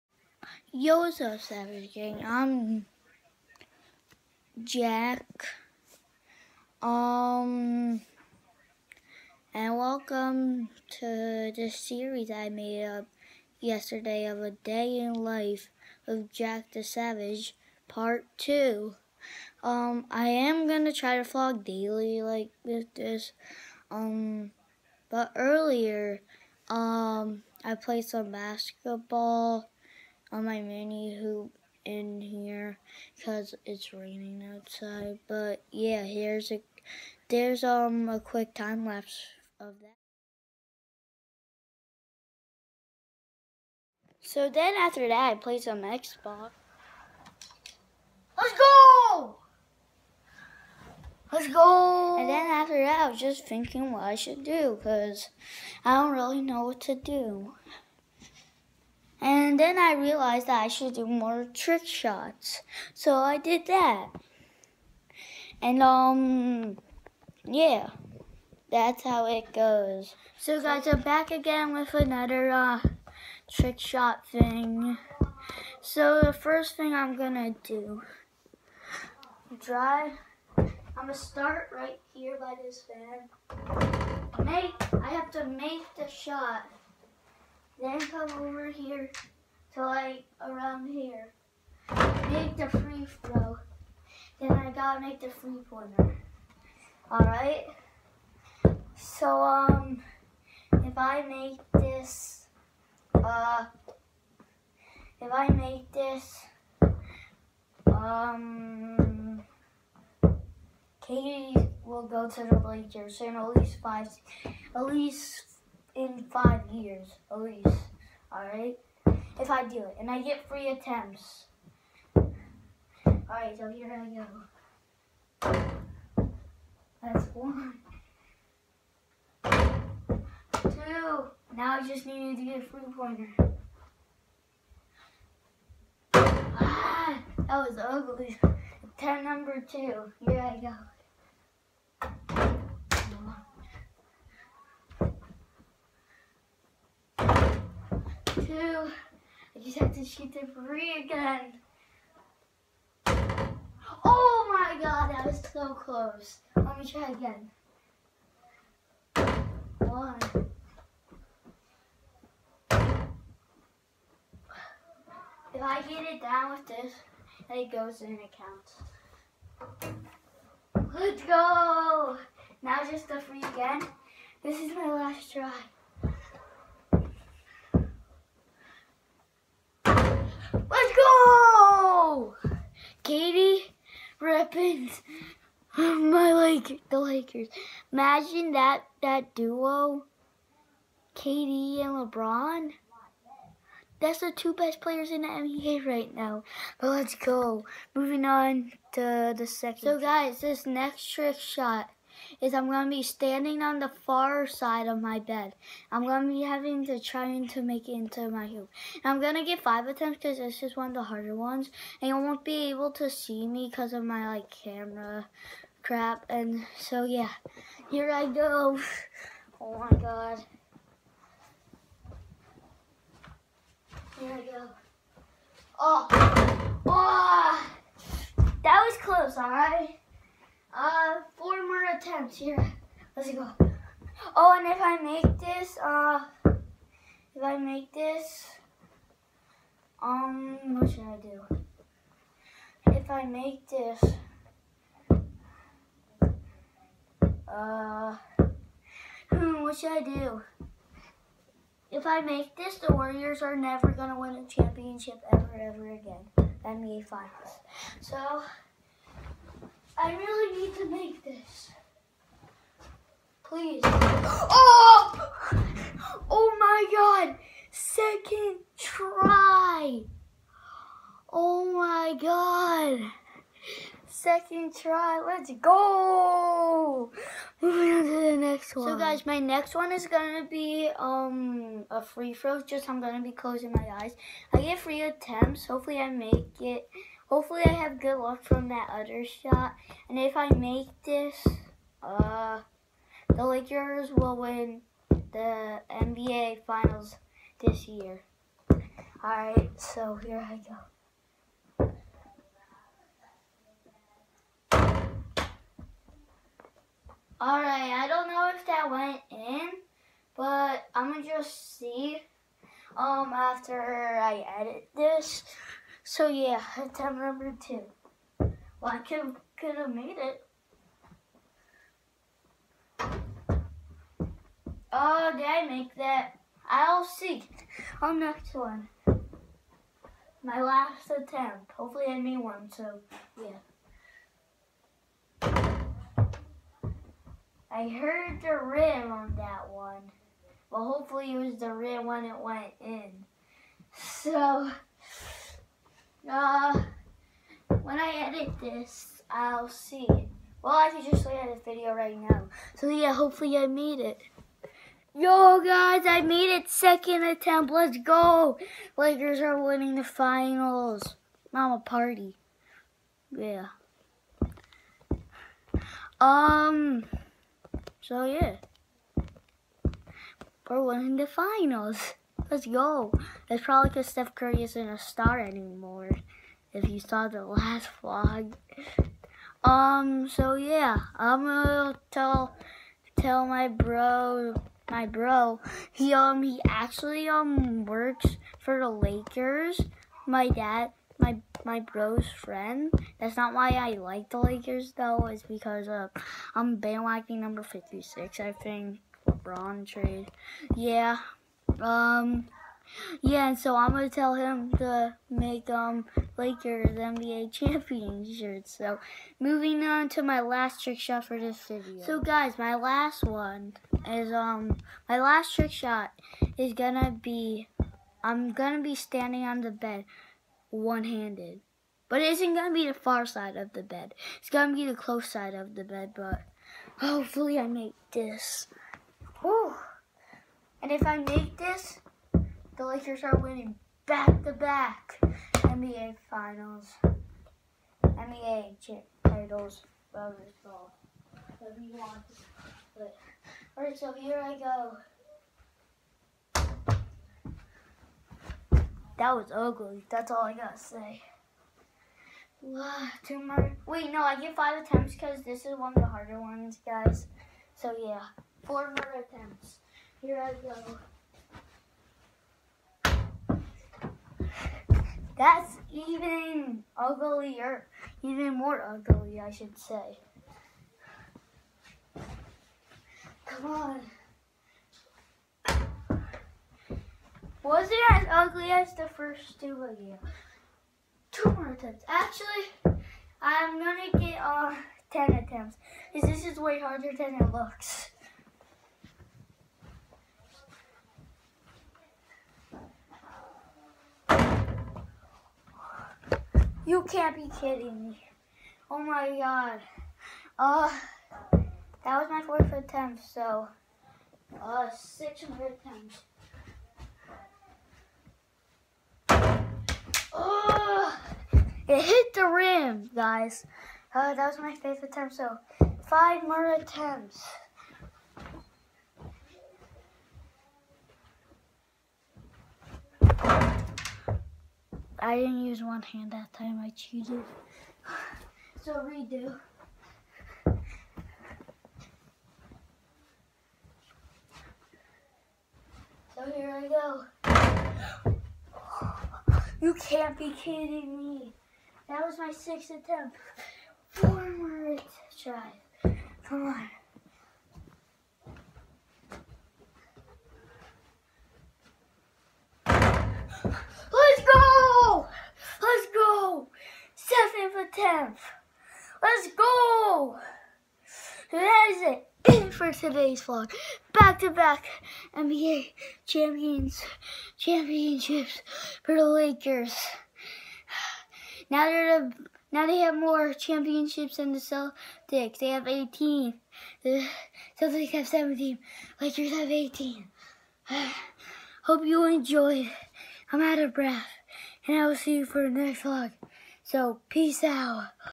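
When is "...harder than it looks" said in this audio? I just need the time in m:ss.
8:06.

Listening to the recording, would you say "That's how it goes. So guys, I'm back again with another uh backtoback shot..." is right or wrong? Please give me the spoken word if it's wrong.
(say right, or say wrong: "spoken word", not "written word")
wrong: "trick", not "backtoback".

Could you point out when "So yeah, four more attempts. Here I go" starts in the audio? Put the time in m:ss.
7:37.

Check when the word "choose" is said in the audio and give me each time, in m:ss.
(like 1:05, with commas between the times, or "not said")
not said.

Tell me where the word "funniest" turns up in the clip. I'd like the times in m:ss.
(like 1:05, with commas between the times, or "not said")
not said.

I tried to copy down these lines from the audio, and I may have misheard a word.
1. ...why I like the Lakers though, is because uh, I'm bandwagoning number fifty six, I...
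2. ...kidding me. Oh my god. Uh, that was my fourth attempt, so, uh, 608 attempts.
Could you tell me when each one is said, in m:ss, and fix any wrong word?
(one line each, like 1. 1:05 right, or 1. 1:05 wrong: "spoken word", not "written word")
1. 6:33 right
2. 8:17 wrong: "600", not "608".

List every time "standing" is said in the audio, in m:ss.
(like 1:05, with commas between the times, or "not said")
3:23, 6:58.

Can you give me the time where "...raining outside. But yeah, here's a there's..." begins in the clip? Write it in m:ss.
0:33.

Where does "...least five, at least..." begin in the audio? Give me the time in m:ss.
1:53.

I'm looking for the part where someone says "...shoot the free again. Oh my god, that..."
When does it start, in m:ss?
2:30.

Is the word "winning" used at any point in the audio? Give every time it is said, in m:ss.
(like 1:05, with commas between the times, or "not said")
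5:59, 6:10, 7:13.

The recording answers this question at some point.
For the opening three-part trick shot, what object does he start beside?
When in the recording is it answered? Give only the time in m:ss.
1:22.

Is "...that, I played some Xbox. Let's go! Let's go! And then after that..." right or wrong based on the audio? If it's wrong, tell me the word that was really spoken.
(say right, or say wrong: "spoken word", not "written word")
right.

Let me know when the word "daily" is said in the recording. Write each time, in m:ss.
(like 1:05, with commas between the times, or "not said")
0:21.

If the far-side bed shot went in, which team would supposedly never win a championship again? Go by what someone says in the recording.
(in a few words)
Warriors.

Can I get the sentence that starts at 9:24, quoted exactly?
Back to back NBA champions, championships for the Lakers.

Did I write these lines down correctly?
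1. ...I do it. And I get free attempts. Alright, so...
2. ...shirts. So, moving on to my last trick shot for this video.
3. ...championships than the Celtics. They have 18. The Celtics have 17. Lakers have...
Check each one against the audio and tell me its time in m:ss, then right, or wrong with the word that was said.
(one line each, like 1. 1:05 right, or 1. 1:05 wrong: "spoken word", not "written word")
1. 1:59 right
2. 6:48 right
3. 9:33 right.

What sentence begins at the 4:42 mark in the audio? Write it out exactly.
Just I'm gonna be closing my eyes.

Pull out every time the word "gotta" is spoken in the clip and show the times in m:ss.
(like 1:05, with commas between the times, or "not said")
1:34, 7:30.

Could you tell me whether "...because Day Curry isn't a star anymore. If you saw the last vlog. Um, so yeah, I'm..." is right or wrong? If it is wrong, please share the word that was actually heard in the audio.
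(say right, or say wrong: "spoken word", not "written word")
wrong: "Steph", not "Day".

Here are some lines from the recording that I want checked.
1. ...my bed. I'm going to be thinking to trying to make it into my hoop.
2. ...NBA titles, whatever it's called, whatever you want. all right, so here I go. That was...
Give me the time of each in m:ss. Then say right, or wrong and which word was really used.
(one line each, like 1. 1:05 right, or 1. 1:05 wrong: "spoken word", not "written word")
1. 3:25 wrong: "having", not "thinking"
2. 7:18 right.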